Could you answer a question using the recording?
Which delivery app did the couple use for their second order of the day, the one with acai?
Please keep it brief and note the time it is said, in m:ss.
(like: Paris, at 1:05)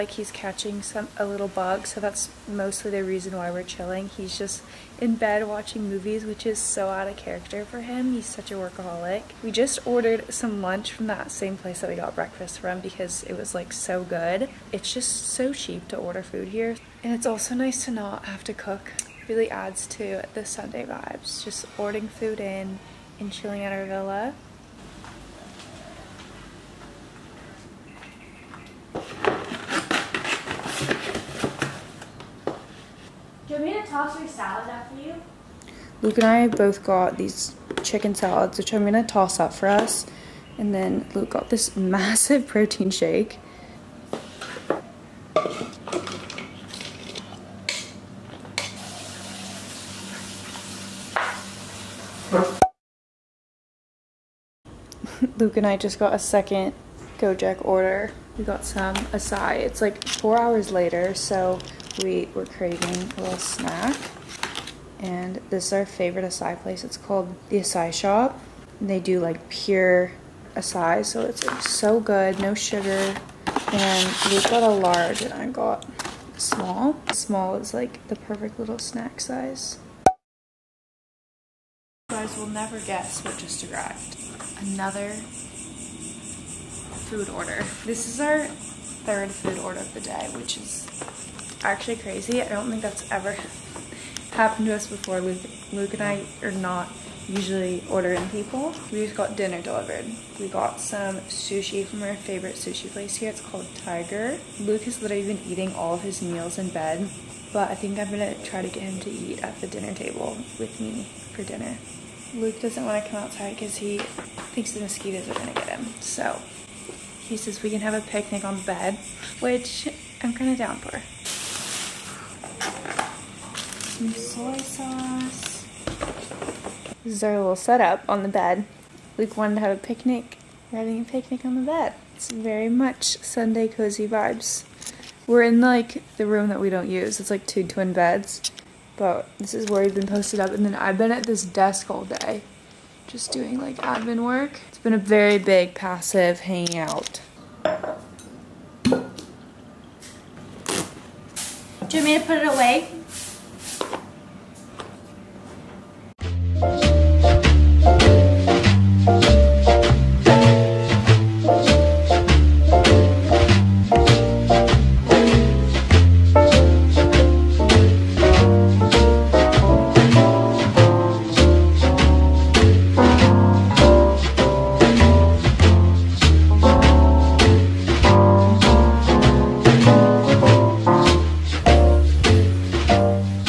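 Gojek, at 0:57.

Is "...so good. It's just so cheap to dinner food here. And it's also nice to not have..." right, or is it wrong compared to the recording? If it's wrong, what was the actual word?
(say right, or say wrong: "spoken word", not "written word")
wrong: "order", not "dinner".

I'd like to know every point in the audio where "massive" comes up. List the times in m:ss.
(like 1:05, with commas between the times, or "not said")
0:41.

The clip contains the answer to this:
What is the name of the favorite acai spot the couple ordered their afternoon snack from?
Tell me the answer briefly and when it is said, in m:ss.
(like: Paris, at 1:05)
The Acai Shop, at 1:07.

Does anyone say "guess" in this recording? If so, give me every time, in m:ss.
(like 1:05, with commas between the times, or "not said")
1:22.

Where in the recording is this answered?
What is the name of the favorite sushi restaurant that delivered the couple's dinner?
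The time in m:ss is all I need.
1:43.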